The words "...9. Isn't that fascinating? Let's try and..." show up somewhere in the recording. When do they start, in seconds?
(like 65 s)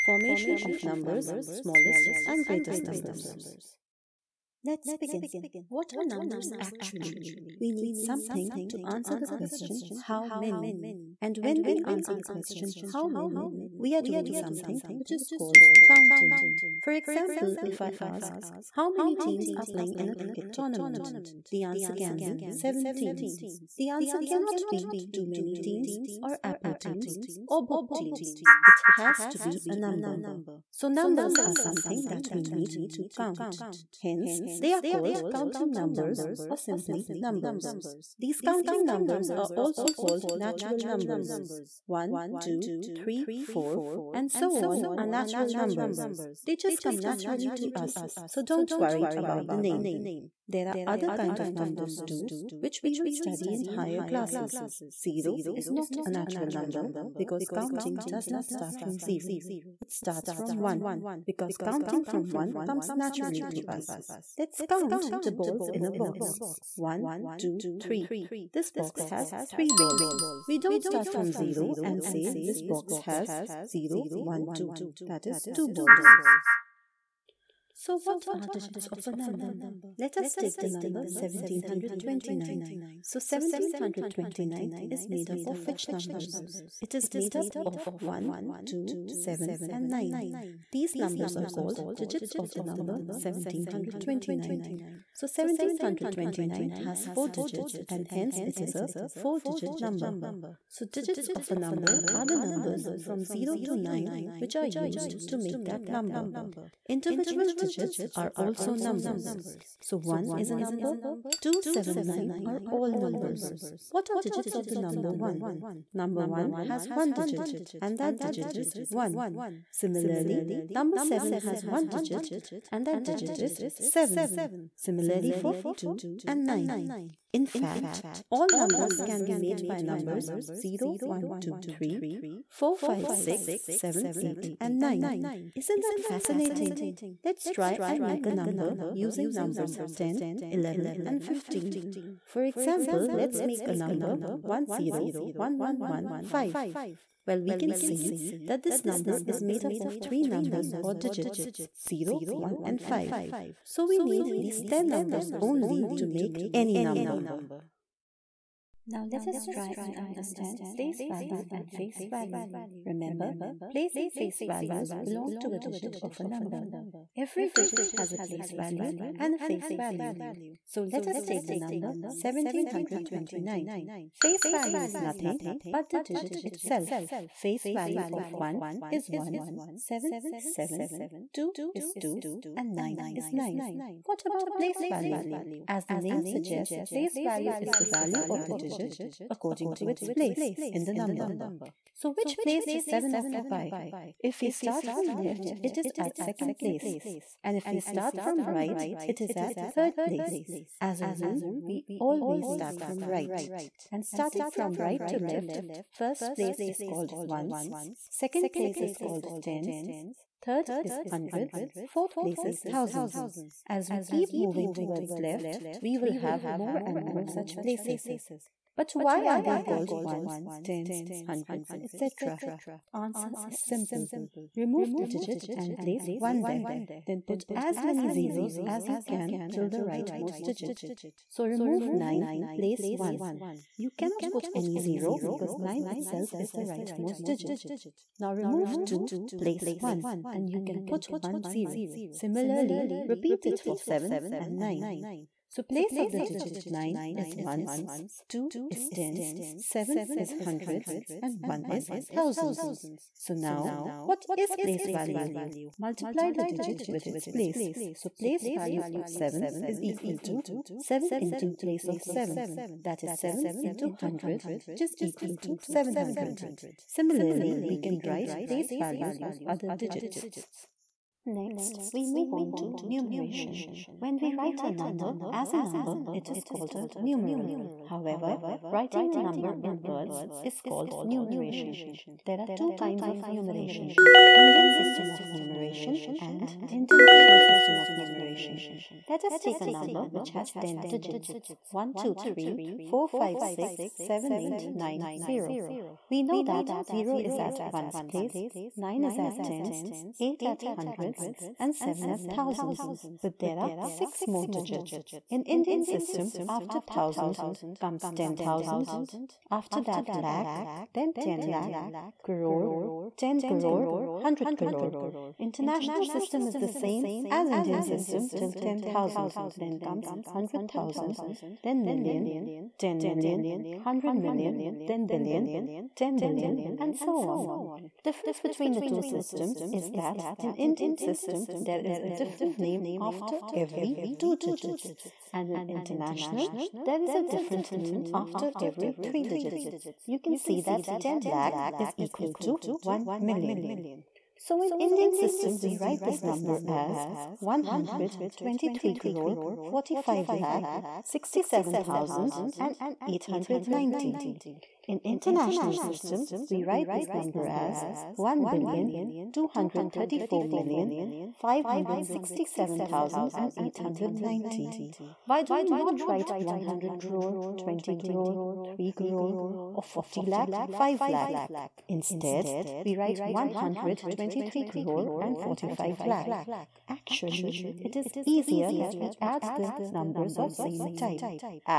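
134 s.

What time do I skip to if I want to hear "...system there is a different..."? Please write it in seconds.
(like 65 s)
330 s.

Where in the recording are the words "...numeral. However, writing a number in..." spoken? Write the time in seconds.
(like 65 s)
276 s.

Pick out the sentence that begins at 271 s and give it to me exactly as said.
Next, we move on to numeration.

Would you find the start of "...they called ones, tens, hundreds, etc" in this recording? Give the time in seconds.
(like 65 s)
219 s.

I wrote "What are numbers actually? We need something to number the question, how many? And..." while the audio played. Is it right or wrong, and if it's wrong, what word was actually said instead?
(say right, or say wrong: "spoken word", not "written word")
wrong: "answer", not "number".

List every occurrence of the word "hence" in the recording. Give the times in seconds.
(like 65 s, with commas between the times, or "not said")
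34 s, 98 s.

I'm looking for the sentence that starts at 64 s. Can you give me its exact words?
Let's count the balls in a box.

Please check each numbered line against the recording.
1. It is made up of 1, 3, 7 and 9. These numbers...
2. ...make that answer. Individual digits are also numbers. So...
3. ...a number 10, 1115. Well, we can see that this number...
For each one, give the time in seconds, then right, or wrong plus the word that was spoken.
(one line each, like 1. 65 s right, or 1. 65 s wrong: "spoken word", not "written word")
1. 86 s wrong: "2", not "3"
2. 105 s wrong: "number", not "answer"
3. 143 s right.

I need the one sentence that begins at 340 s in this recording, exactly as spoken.
You can see that 10 lakh is equal to 1 million.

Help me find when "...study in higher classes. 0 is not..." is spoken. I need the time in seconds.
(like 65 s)
53 s.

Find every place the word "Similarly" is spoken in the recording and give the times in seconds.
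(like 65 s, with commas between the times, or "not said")
119 s, 124 s, 242 s, 266 s.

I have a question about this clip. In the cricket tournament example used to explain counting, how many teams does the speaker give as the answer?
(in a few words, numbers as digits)
7.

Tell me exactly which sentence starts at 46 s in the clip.
They just come naturally to us, so don't worry about the name.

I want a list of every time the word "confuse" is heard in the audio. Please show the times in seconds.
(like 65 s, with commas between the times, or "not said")
not said.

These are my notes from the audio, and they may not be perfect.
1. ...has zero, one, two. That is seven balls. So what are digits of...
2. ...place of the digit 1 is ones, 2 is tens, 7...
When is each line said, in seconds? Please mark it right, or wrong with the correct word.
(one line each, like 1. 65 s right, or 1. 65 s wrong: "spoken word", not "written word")
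1. 73 s wrong: "two", not "seven"
2. 245 s wrong: "9", not "1".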